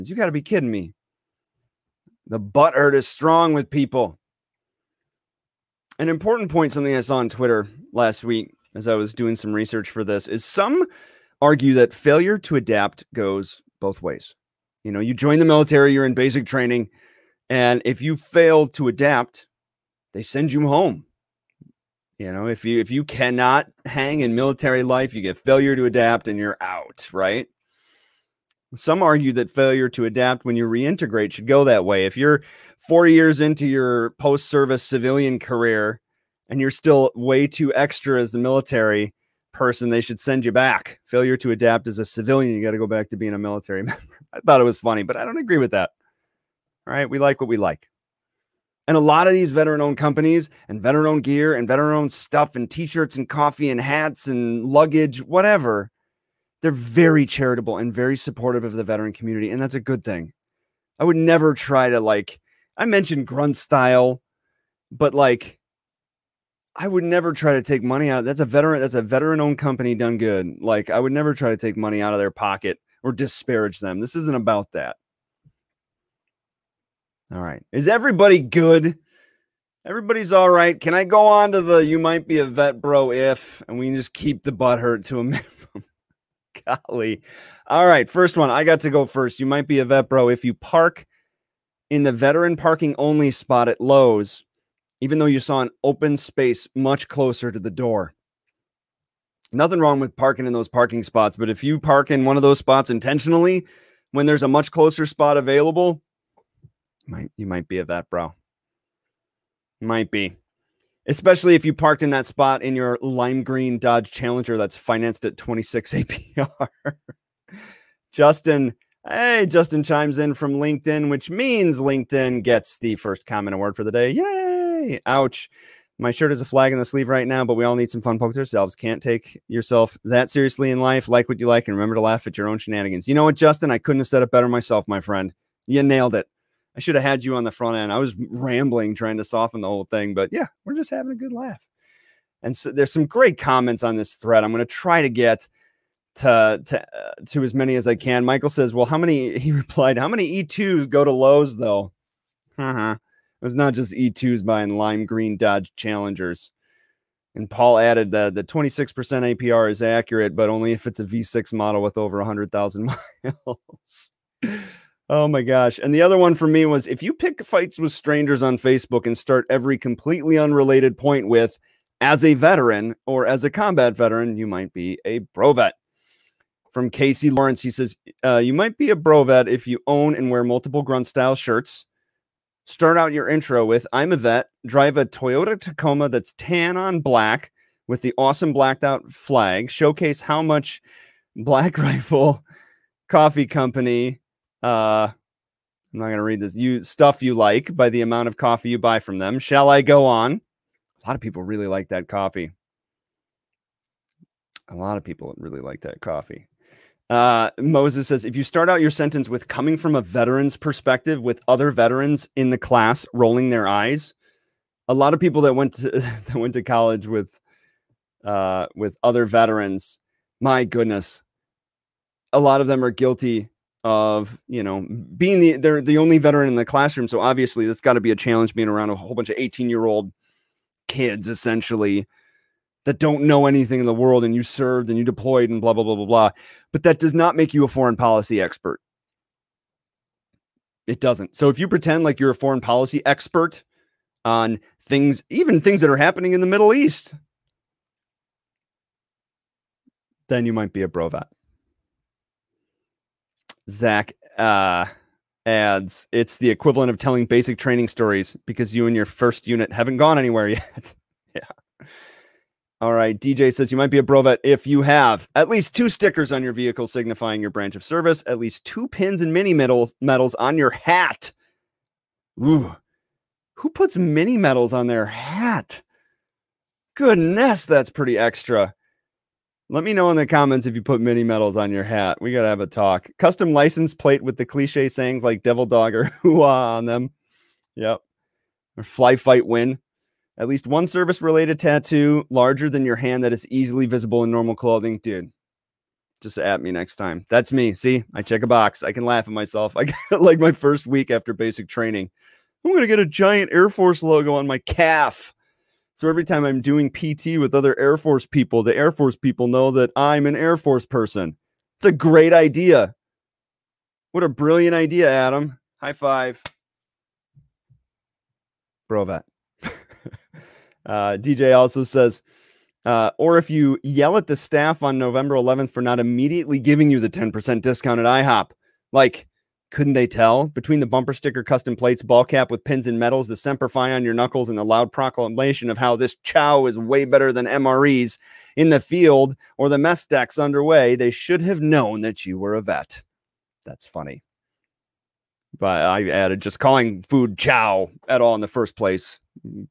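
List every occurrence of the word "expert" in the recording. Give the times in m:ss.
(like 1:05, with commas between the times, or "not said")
3:58, 4:03.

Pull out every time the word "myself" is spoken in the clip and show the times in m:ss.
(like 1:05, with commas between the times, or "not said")
2:14, 4:59.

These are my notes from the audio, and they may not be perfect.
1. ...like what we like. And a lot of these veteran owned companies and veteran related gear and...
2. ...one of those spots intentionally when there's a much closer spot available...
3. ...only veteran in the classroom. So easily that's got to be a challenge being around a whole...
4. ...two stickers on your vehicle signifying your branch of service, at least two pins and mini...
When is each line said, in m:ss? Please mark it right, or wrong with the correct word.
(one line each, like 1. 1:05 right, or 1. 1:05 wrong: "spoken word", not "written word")
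1. 0:47 wrong: "owned", not "related"
2. 1:42 right
3. 3:45 wrong: "obviously", not "easily"
4. 4:25 right.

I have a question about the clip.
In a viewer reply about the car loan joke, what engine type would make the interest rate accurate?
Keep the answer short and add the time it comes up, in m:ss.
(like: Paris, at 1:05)
V6, at 2:41.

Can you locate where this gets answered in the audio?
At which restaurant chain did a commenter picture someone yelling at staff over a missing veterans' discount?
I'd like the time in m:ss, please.
5:28.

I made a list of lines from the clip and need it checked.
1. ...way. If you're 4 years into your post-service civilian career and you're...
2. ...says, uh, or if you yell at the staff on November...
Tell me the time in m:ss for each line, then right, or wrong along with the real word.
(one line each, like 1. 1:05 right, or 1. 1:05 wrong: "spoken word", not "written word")
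1. 0:31 right
2. 5:21 right.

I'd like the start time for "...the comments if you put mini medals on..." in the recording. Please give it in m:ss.
4:40.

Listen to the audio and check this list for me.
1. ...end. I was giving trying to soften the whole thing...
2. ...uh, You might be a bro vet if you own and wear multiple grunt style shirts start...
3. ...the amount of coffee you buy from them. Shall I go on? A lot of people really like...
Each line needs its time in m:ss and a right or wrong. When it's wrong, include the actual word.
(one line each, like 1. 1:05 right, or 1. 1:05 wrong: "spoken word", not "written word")
1. 2:17 wrong: "rambling", not "giving"
2. 2:58 right
3. 3:17 right.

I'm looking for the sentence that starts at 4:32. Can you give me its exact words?
Ooh, who puts mini medals on their hat?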